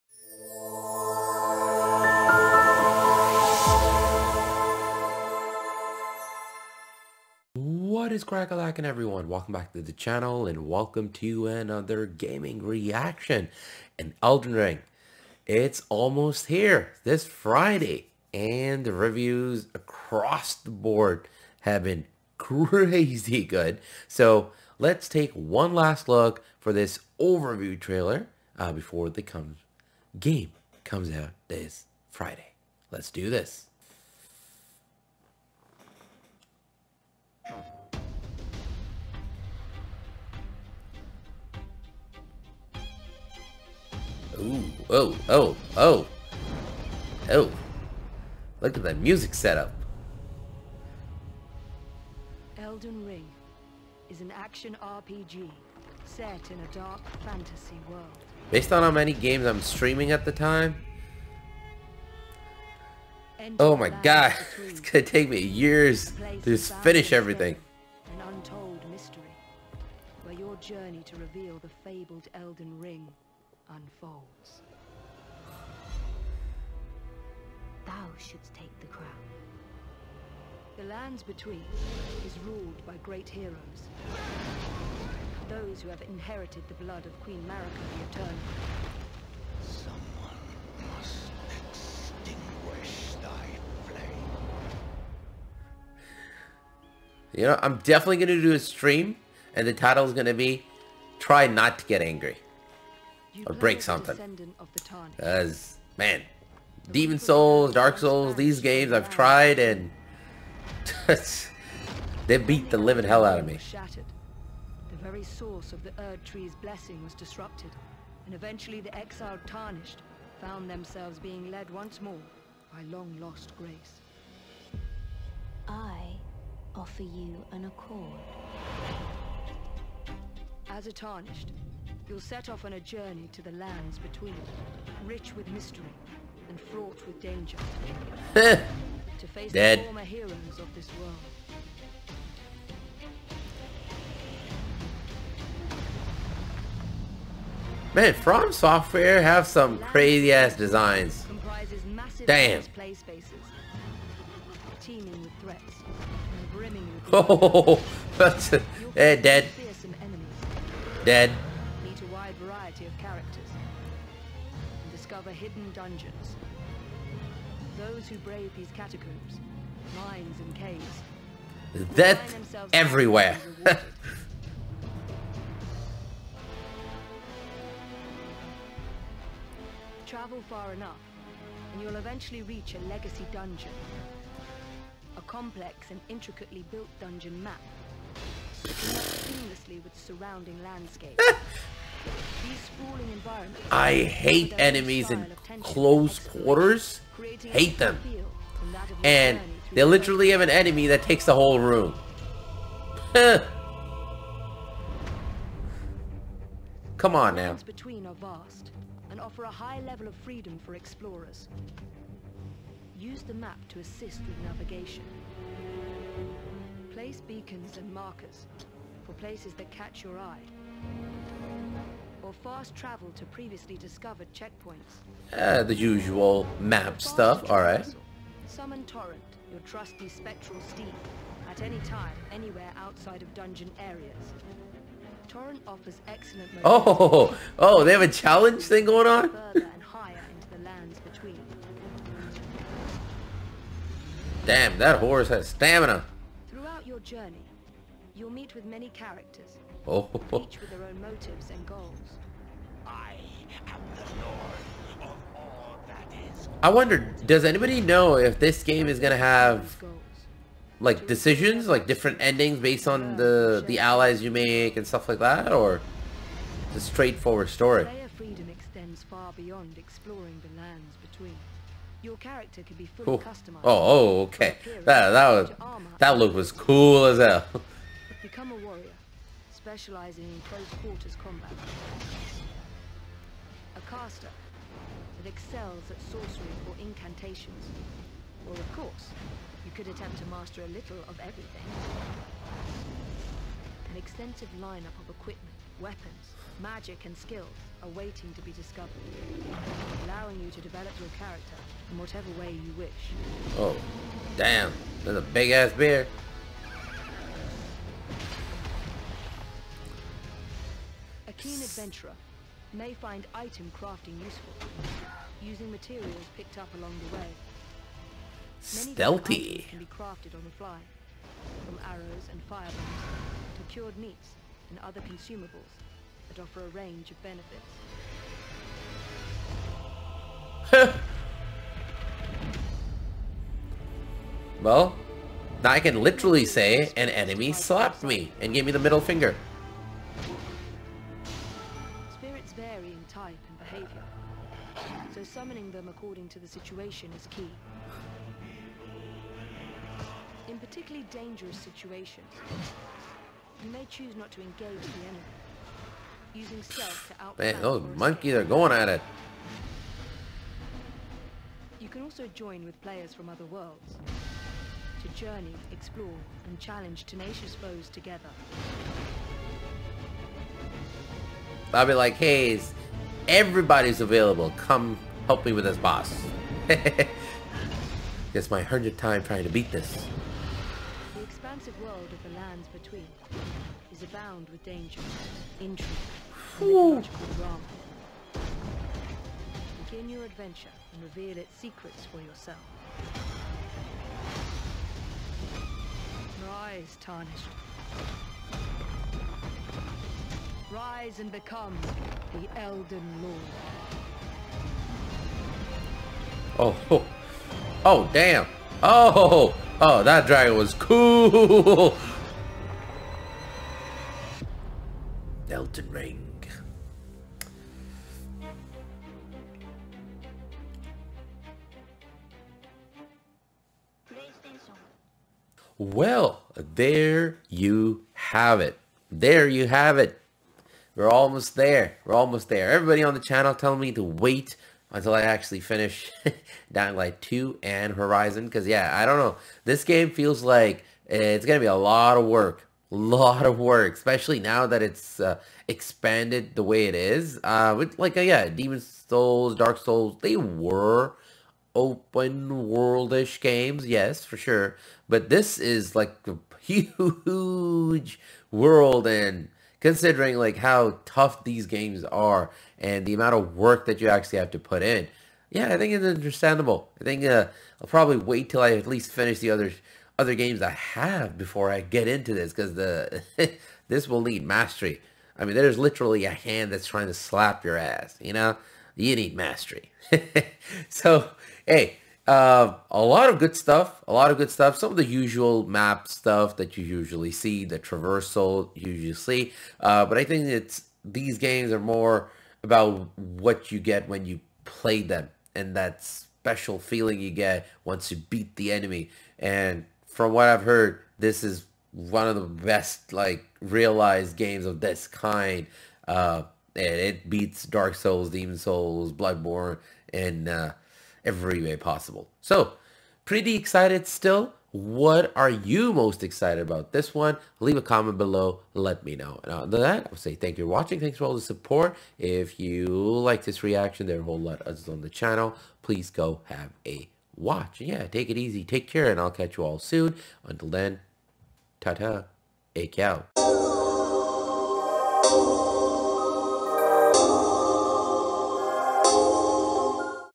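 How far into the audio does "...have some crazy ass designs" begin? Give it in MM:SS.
02:29.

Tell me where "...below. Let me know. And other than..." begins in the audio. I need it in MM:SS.
08:38.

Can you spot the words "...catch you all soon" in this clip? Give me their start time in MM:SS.
08:49.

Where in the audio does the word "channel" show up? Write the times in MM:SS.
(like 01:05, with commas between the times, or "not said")
00:09, 07:13, 08:45.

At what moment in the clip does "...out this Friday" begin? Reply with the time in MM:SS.
00:31.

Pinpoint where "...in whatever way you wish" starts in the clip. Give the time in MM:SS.
05:01.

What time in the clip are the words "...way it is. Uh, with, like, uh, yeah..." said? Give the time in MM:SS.
07:26.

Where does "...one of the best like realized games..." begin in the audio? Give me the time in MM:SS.
08:21.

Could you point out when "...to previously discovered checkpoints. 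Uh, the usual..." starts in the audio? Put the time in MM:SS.
03:43.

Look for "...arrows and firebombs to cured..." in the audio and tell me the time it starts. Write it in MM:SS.
05:21.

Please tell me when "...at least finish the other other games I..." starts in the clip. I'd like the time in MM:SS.
07:48.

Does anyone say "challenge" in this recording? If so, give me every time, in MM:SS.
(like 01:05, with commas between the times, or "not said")
03:58, 06:06.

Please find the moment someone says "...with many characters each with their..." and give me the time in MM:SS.
04:08.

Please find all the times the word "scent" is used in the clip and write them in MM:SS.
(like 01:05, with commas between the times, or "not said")
not said.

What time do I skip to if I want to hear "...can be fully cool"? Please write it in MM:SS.
04:32.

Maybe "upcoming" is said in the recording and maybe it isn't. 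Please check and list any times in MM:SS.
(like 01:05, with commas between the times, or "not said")
not said.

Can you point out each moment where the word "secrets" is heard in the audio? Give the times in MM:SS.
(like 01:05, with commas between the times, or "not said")
06:31.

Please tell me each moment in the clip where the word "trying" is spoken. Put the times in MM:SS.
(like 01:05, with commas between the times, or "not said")
06:19, 07:56.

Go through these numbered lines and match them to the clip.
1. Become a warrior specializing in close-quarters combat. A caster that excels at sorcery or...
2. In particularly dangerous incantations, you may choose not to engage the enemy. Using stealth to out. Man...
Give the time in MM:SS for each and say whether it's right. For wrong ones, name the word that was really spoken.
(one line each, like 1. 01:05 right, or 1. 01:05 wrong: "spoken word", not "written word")
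1. 04:38 right
2. 05:50 wrong: "situations", not "incantations".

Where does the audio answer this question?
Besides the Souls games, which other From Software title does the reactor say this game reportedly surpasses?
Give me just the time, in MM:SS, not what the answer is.
08:29.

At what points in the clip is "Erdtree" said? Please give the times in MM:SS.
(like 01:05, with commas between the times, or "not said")
01:55.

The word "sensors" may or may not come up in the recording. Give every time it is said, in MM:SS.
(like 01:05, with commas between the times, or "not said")
not said.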